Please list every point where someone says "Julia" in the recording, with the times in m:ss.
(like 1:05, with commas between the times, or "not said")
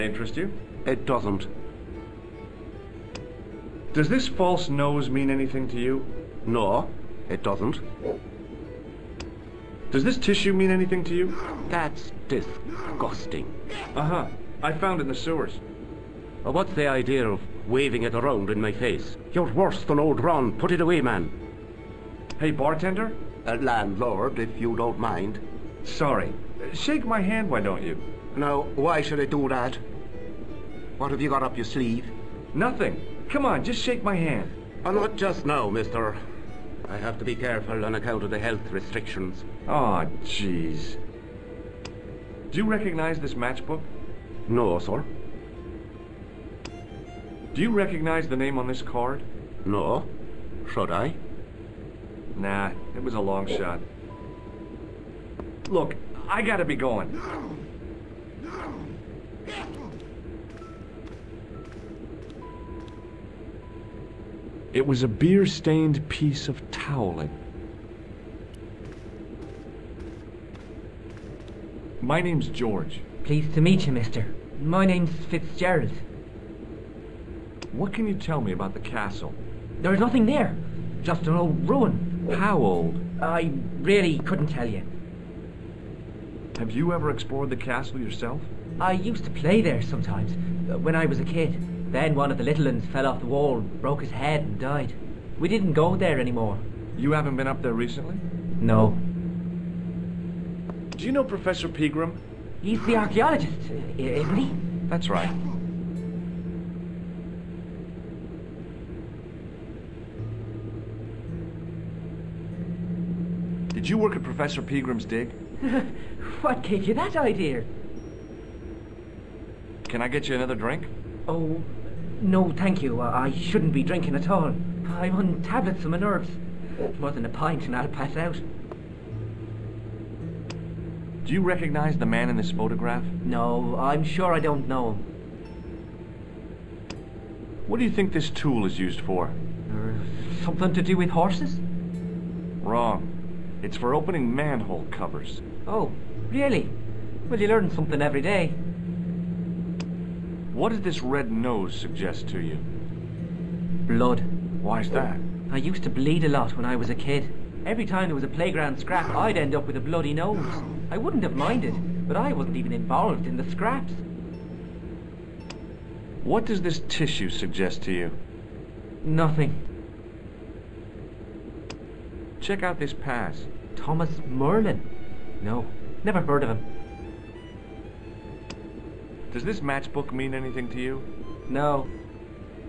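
not said.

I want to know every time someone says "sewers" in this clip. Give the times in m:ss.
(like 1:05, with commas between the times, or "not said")
0:15.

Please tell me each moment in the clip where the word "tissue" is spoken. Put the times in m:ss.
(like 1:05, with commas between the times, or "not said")
0:10, 2:46.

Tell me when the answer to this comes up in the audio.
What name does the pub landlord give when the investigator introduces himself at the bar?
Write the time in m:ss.
1:15.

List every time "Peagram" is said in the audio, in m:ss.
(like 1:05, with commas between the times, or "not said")
1:41, 1:54.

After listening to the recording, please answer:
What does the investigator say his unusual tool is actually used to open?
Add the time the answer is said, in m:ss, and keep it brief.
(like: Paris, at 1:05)
Manhole covers, at 2:24.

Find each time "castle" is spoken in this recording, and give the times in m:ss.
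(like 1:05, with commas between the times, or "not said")
1:18, 1:27.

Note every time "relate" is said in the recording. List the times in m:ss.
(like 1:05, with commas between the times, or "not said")
not said.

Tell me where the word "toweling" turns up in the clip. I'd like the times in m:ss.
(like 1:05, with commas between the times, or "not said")
1:06.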